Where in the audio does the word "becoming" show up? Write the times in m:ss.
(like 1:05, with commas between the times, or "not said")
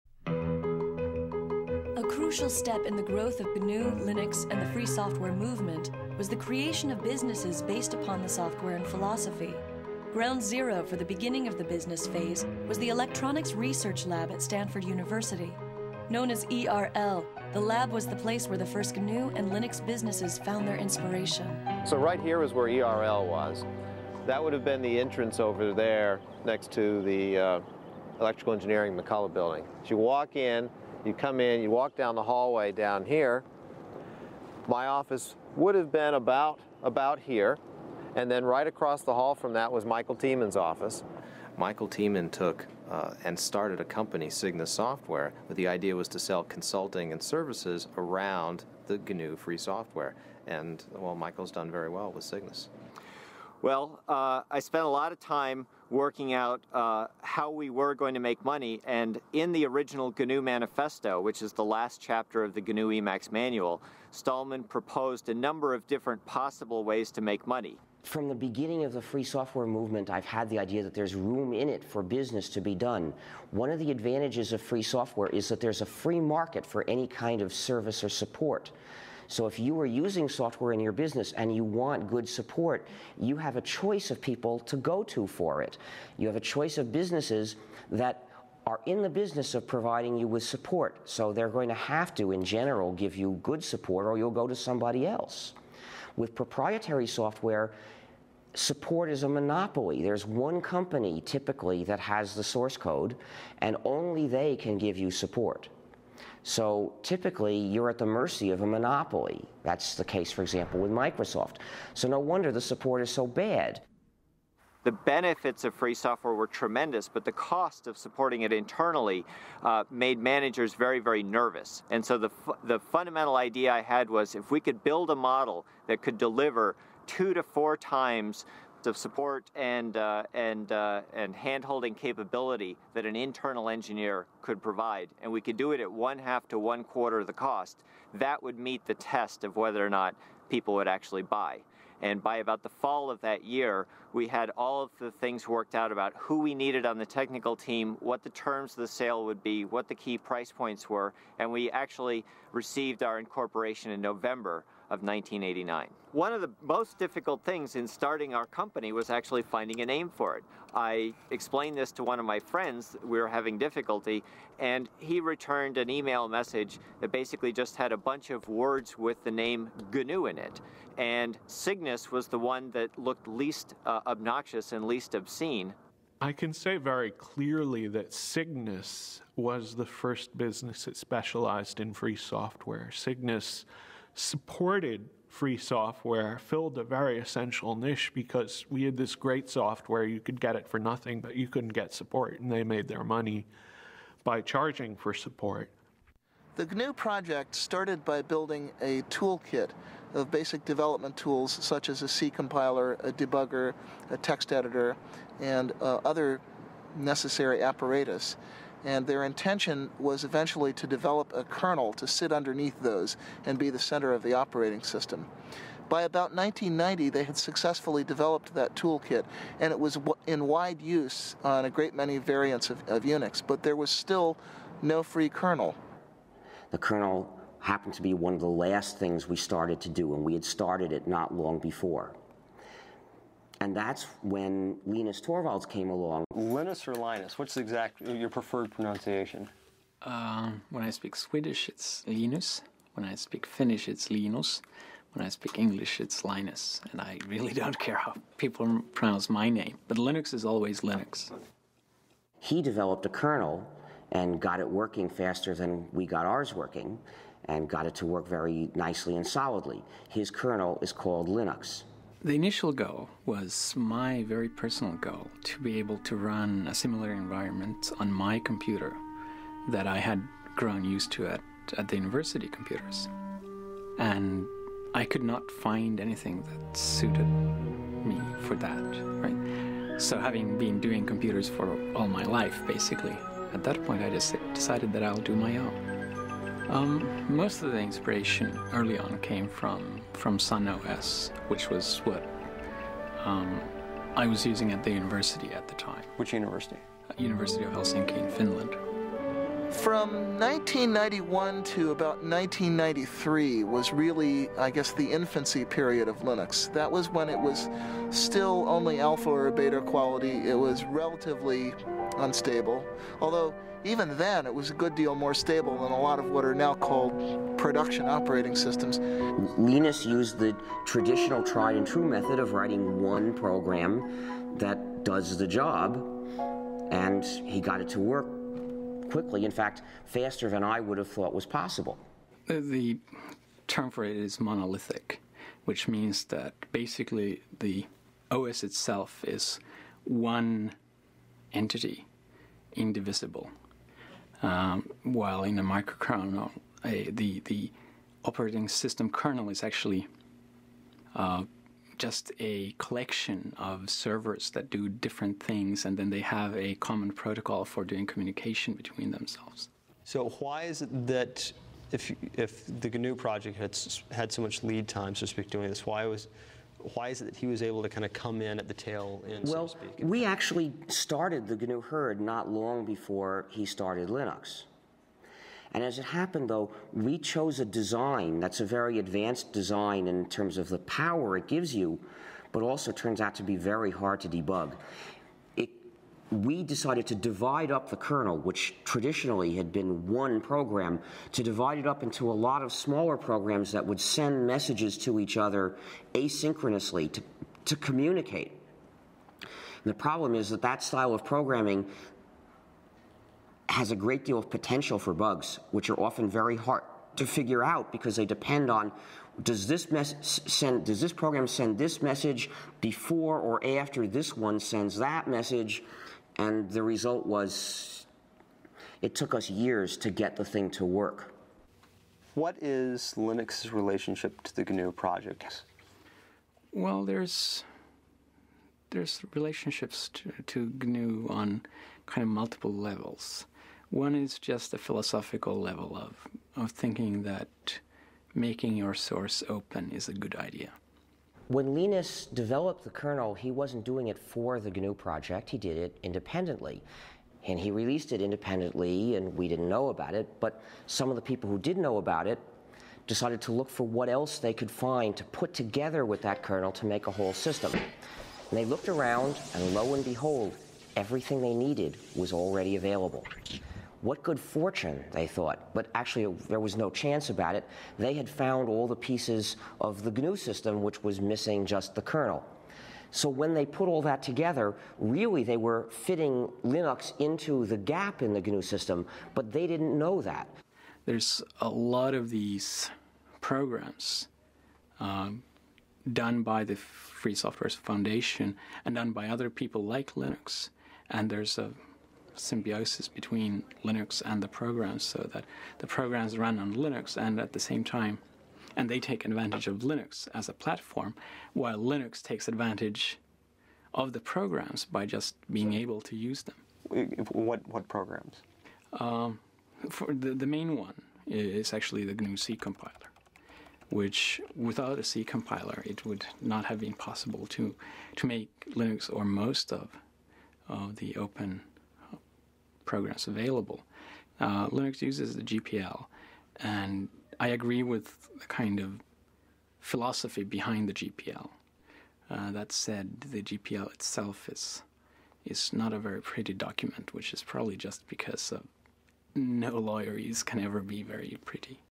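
not said.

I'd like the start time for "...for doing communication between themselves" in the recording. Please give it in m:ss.
5:57.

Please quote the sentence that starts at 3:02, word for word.
Cygnus supported free software filled a very essential niche because we had this great software.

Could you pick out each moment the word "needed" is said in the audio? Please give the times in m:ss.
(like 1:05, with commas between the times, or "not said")
2:26, 7:41.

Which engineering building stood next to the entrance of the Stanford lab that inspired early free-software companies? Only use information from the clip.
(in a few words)
McCullough building.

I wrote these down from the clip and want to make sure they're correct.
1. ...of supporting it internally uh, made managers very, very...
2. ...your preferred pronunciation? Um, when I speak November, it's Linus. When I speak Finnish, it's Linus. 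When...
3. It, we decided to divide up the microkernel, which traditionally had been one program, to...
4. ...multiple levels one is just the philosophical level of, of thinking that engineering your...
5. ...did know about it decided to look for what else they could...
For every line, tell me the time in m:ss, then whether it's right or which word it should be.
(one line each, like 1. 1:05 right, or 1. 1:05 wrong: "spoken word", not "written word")
1. 1:57 right
2. 3:58 wrong: "Swedish", not "November"
3. 6:25 wrong: "kernel", not "microkernel"
4. 7:12 wrong: "making", not "engineering"
5. 7:31 right.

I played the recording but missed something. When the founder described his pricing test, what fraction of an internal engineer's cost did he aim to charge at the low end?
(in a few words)
one quarter.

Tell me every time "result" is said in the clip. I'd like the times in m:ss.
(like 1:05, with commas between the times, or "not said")
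6:56.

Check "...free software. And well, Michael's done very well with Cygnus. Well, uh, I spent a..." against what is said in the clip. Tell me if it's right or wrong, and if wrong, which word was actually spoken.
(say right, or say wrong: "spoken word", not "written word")
right.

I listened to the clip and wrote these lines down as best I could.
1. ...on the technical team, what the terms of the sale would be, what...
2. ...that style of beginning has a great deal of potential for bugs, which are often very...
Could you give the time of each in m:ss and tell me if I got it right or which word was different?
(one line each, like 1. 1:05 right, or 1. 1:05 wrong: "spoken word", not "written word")
1. 2:26 right
2. 6:40 wrong: "programming", not "beginning".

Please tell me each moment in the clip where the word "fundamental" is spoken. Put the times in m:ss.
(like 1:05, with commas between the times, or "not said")
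2:02.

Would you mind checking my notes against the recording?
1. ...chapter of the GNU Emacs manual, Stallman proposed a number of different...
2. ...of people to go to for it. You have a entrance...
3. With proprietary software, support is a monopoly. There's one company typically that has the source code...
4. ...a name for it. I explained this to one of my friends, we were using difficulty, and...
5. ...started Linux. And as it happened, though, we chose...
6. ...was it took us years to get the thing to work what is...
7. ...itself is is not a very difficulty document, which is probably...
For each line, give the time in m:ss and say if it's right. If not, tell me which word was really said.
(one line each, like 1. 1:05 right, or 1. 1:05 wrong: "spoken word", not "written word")
1. 1:02 right
2. 1:24 wrong: "choice", not "entrance"
3. 1:36 right
4. 2:39 wrong: "having", not "using"
5. 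6:13 right
6. 6:57 right
7. 8:53 wrong: "pretty", not "difficulty".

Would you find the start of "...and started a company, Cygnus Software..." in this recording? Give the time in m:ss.
0:43.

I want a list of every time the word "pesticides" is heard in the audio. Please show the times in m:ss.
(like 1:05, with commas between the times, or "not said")
not said.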